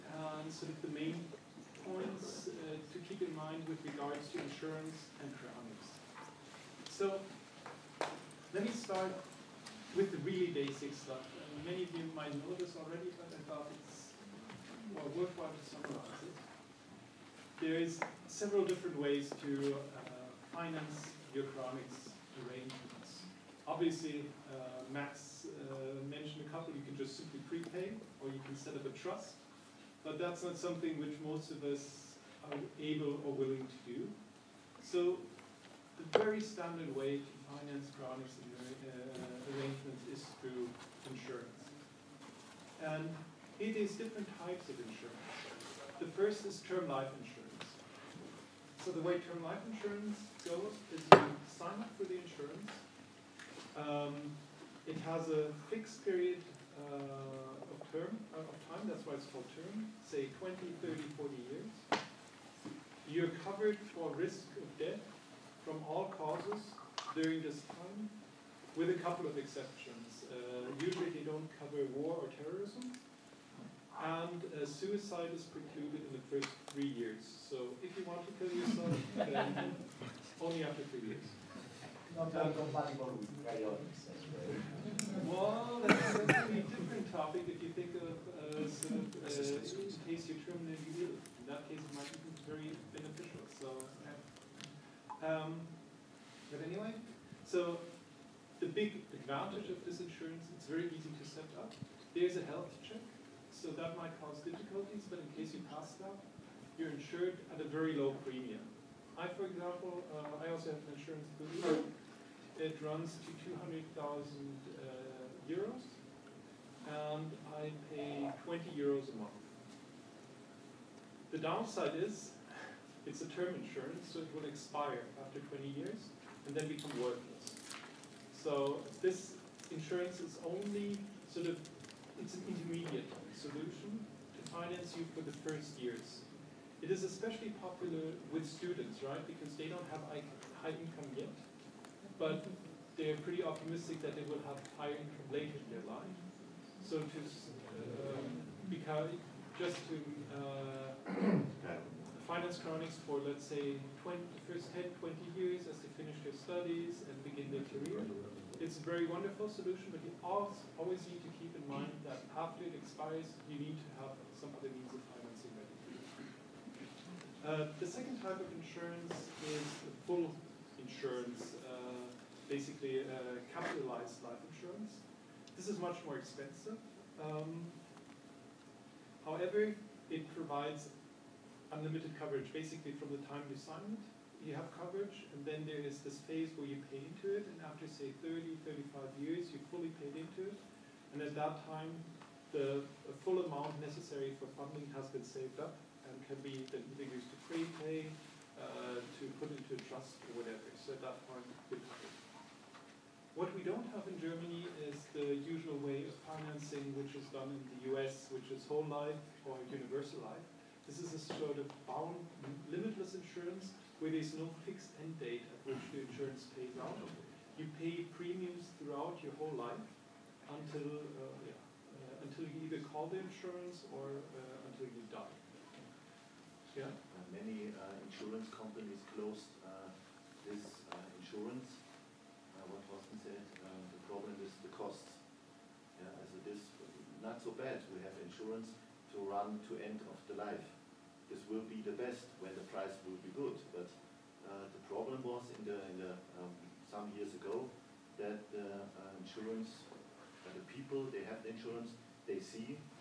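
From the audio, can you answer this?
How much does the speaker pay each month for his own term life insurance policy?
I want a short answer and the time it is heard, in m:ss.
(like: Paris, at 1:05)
20 euros, at 1:58.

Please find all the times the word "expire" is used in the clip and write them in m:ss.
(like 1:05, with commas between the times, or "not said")
2:04, 2:42.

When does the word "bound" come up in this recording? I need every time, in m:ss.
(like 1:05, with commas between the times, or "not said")
3:31.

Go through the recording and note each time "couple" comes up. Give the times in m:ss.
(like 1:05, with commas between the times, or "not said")
0:26, 1:09.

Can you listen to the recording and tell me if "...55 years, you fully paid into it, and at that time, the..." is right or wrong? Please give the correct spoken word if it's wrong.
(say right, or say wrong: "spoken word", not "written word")
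wrong: "35", not "55".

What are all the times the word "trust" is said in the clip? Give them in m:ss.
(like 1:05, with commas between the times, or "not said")
0:28, 3:19.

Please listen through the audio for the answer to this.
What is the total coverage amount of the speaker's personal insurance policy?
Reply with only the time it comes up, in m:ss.
1:53.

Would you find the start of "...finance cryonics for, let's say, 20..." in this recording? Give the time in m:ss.
2:32.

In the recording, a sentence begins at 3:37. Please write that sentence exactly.
You pay premiums throughout your whole life until uh, yeah, uh, until you either call the insurance or uh, until you die.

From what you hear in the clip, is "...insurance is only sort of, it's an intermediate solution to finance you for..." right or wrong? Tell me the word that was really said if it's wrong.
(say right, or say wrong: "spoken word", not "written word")
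right.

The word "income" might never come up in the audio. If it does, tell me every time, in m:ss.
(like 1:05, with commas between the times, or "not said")
2:20, 2:24.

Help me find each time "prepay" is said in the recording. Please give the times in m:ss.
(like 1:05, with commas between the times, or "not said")
0:27, 3:17.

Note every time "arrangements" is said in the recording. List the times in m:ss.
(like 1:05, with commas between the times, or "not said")
0:22, 0:39.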